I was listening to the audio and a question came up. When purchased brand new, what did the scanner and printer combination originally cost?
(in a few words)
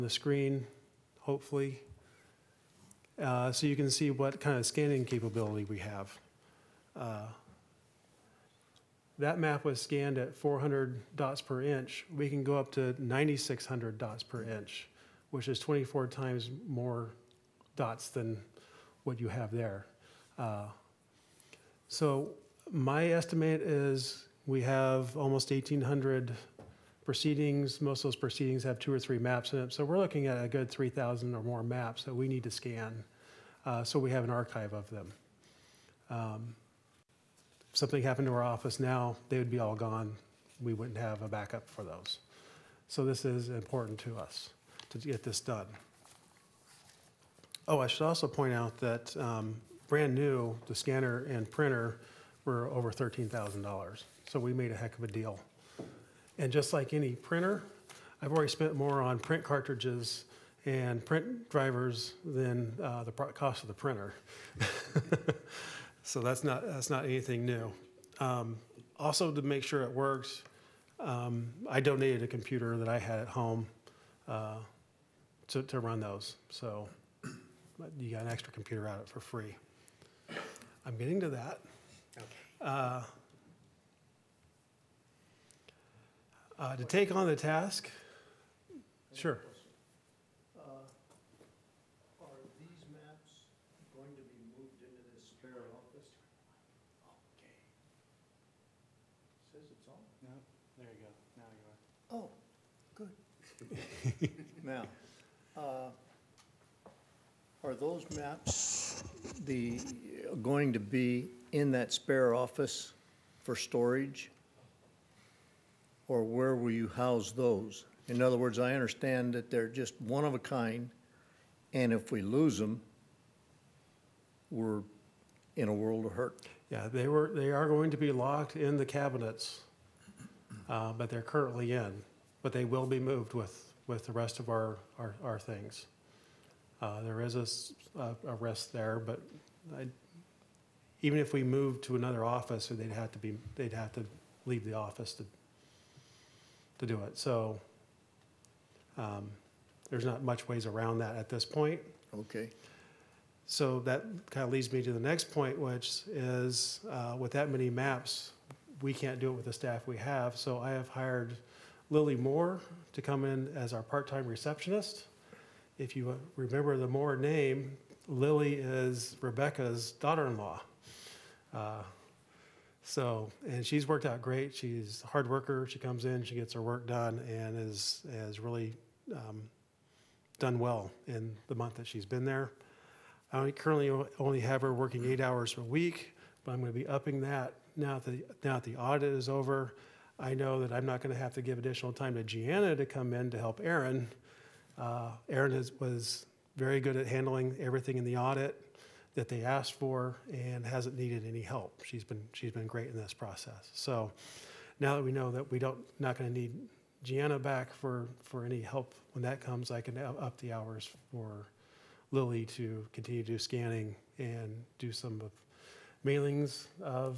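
$13,000.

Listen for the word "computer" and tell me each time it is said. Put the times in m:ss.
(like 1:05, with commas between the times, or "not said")
1:12, 1:18.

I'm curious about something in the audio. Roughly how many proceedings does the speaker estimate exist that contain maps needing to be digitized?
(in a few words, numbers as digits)
1,800.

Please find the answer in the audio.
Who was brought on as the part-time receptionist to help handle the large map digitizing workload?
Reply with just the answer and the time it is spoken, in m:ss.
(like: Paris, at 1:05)
Lily Moore, at 2:41.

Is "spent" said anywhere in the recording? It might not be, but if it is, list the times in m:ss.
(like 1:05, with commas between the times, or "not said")
0:58.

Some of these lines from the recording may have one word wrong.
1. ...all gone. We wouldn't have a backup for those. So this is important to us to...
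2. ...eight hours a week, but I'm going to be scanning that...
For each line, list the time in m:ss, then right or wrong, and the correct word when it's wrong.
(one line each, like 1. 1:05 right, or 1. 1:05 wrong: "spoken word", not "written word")
1. 0:39 right
2. 3:05 wrong: "upping", not "scanning".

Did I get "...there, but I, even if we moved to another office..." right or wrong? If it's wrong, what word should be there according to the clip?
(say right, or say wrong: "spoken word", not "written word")
right.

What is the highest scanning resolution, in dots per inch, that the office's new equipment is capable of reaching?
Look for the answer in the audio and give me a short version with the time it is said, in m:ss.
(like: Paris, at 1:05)
9,600, at 0:12.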